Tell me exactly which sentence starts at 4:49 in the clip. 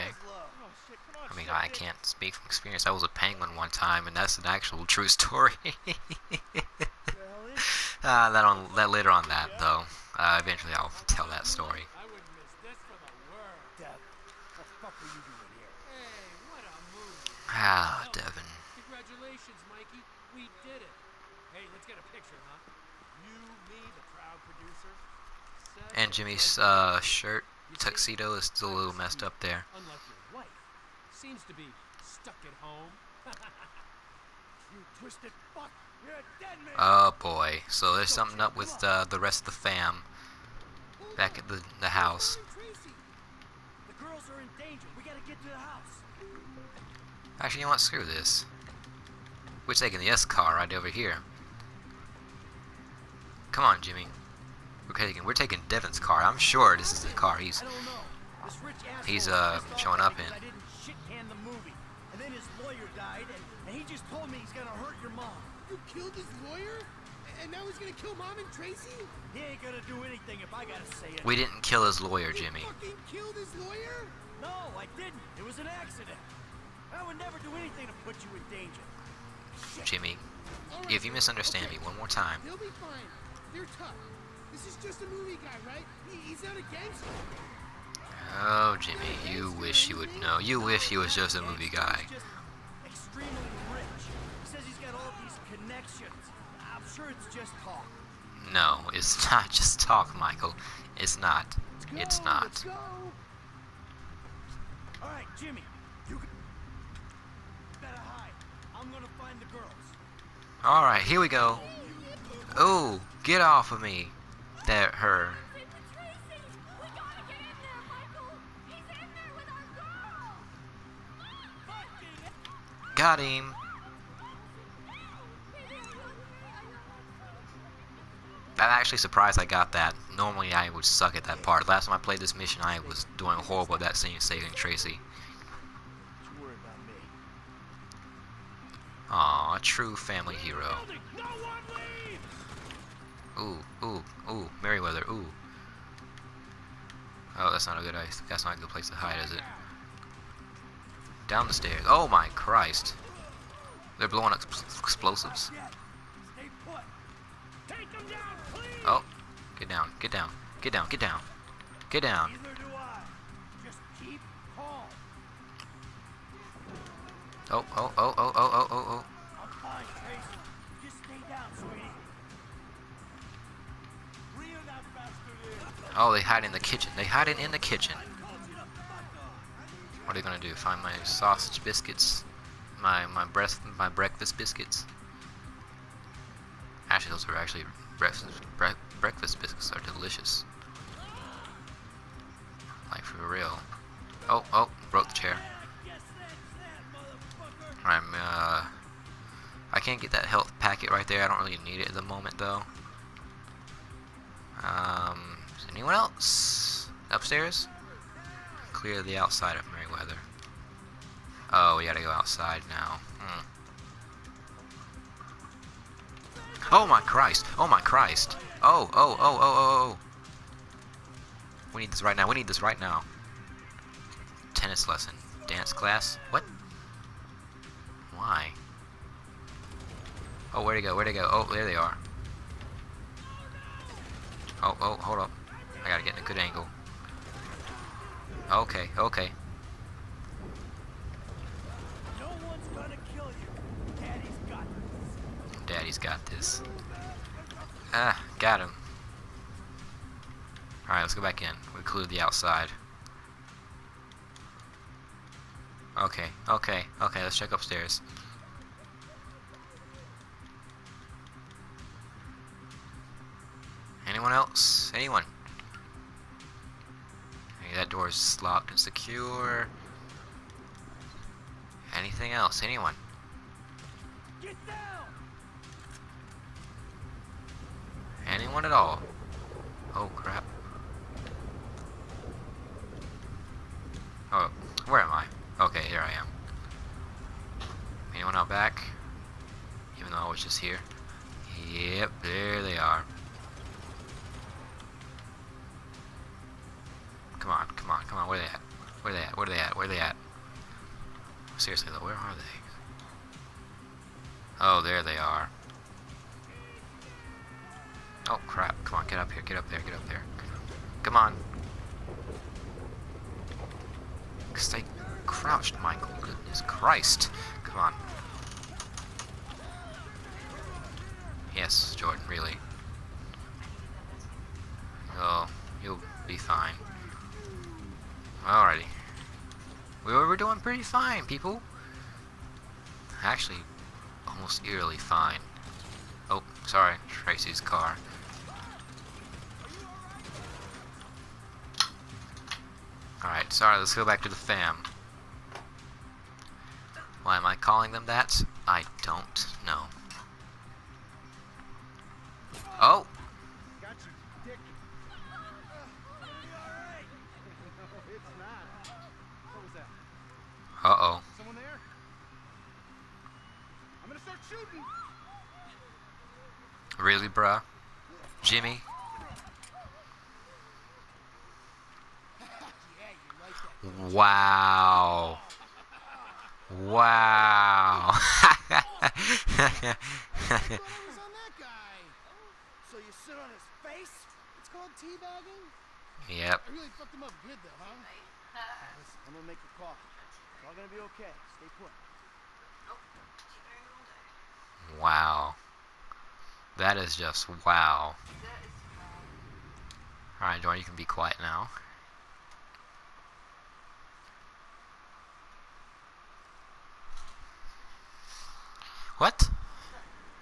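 Even though I was just here.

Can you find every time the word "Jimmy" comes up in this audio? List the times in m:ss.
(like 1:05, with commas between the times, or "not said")
0:26, 0:53, 1:12, 1:19, 1:28, 1:45, 6:08.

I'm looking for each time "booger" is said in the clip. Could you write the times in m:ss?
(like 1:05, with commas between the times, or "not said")
not said.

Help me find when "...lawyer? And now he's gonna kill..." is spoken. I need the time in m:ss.
1:06.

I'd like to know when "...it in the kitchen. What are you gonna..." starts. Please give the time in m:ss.
2:57.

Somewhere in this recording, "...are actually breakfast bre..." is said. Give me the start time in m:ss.
3:07.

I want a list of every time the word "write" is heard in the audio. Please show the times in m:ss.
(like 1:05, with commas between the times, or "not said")
not said.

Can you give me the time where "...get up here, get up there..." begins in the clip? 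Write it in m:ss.
5:09.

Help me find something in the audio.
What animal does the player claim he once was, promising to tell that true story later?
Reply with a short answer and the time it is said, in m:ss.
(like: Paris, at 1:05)
Penguin, at 0:03.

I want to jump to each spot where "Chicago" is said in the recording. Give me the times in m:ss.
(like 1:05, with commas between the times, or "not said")
not said.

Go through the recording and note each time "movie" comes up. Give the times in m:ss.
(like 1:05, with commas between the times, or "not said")
1:25, 1:31.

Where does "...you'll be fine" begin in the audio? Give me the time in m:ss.
5:25.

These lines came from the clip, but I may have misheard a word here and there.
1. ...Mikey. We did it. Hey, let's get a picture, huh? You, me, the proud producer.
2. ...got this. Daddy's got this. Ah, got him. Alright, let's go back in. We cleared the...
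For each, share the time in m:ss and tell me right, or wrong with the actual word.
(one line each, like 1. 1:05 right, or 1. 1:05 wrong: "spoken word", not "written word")
1. 0:19 right
2. 4:04 right.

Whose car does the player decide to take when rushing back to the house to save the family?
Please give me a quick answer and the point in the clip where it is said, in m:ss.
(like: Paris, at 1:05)
Devin's car, at 0:55.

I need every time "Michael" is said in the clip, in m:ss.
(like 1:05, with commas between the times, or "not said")
1:40, 5:15.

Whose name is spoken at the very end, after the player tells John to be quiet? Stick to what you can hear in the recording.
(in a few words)
Lester.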